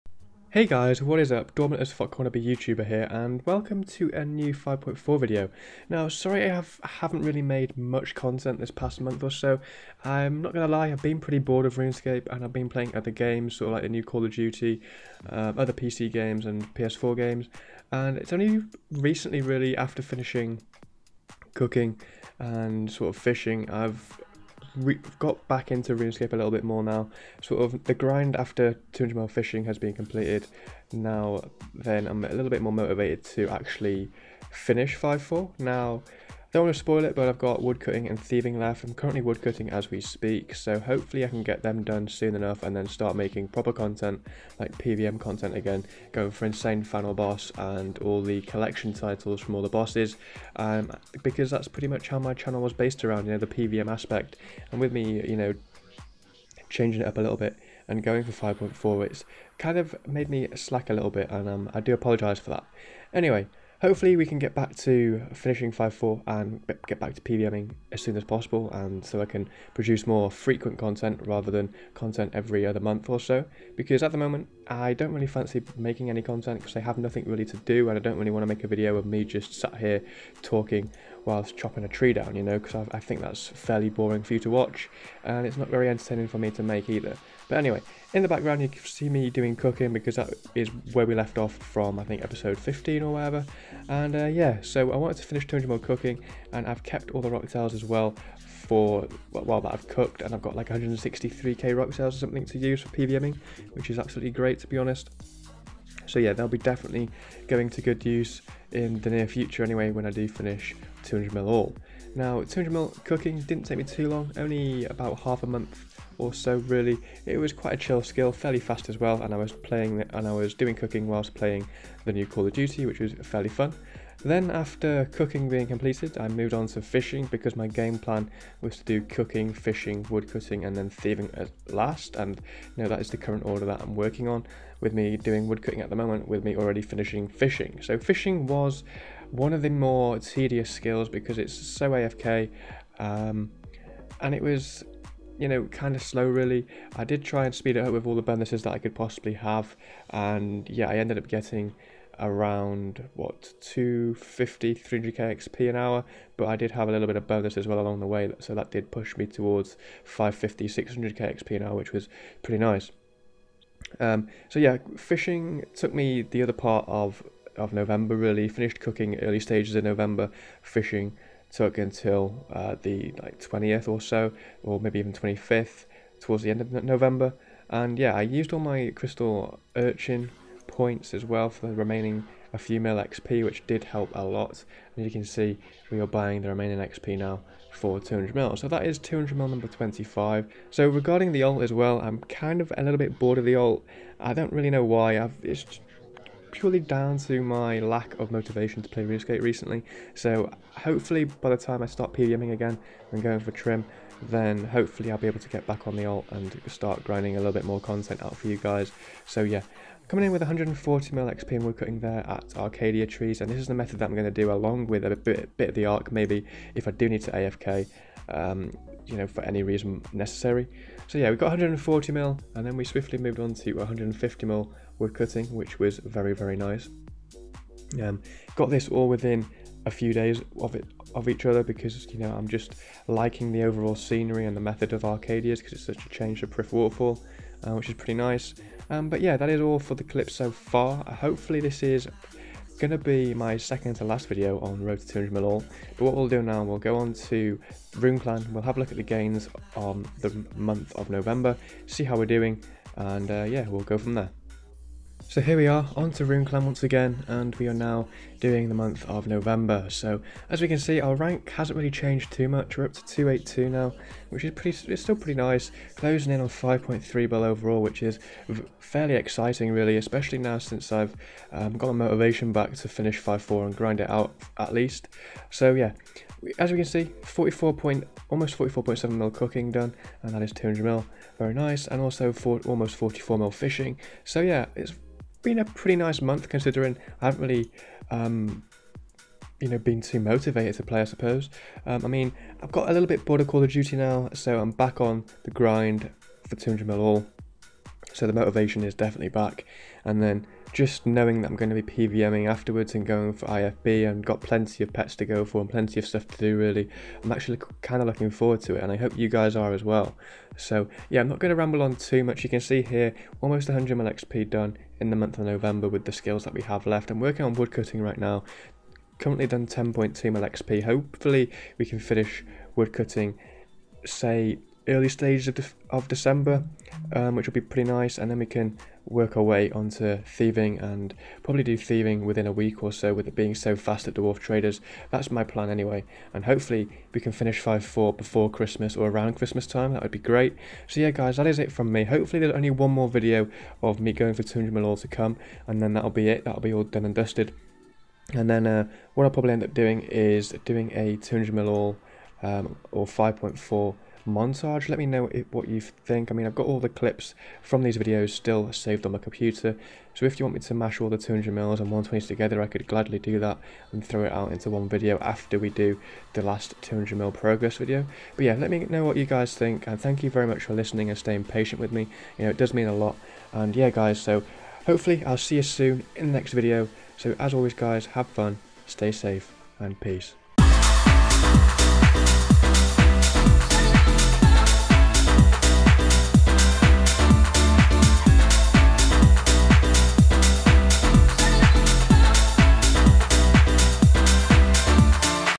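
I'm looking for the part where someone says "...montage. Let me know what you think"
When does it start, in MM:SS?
05:54.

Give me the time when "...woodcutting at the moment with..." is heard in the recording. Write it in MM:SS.
02:15.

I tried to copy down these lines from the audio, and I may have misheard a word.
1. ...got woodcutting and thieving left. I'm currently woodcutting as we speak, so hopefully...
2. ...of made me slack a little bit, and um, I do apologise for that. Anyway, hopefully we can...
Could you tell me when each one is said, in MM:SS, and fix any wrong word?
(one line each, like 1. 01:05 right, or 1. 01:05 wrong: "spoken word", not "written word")
1. 00:37 right
2. 00:59 right.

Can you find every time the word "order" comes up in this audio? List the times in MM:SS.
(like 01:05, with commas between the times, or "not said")
02:13.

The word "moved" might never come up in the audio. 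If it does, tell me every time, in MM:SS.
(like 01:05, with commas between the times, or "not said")
02:06, 03:43.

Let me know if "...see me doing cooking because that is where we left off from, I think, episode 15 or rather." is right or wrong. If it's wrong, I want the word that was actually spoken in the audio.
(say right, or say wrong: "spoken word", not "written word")
wrong: "whatever", not "rather".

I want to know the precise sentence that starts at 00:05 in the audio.
Now, sorry I have, haven't really made much content this past month or so.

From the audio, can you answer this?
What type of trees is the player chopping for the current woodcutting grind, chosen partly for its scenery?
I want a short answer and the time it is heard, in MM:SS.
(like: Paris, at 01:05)
Arcadia Trees, at 03:32.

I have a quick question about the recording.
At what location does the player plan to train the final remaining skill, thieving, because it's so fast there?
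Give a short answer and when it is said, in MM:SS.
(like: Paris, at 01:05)
Dwarf Traders, at 05:34.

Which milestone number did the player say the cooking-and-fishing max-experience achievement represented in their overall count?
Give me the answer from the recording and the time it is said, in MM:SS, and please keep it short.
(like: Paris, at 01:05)
25, at 03:08.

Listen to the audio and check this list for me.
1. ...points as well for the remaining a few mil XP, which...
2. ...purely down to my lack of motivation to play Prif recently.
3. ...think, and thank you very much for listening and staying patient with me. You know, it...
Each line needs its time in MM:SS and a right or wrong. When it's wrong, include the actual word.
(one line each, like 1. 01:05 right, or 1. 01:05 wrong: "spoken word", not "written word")
1. 03:00 right
2. 03:16 wrong: "RuneScape", not "Prif"
3. 06:09 right.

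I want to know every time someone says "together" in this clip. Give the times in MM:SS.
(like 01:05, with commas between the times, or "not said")
06:02.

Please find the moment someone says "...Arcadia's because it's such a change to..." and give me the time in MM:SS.
03:55.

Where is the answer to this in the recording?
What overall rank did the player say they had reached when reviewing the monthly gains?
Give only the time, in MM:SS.
04:23.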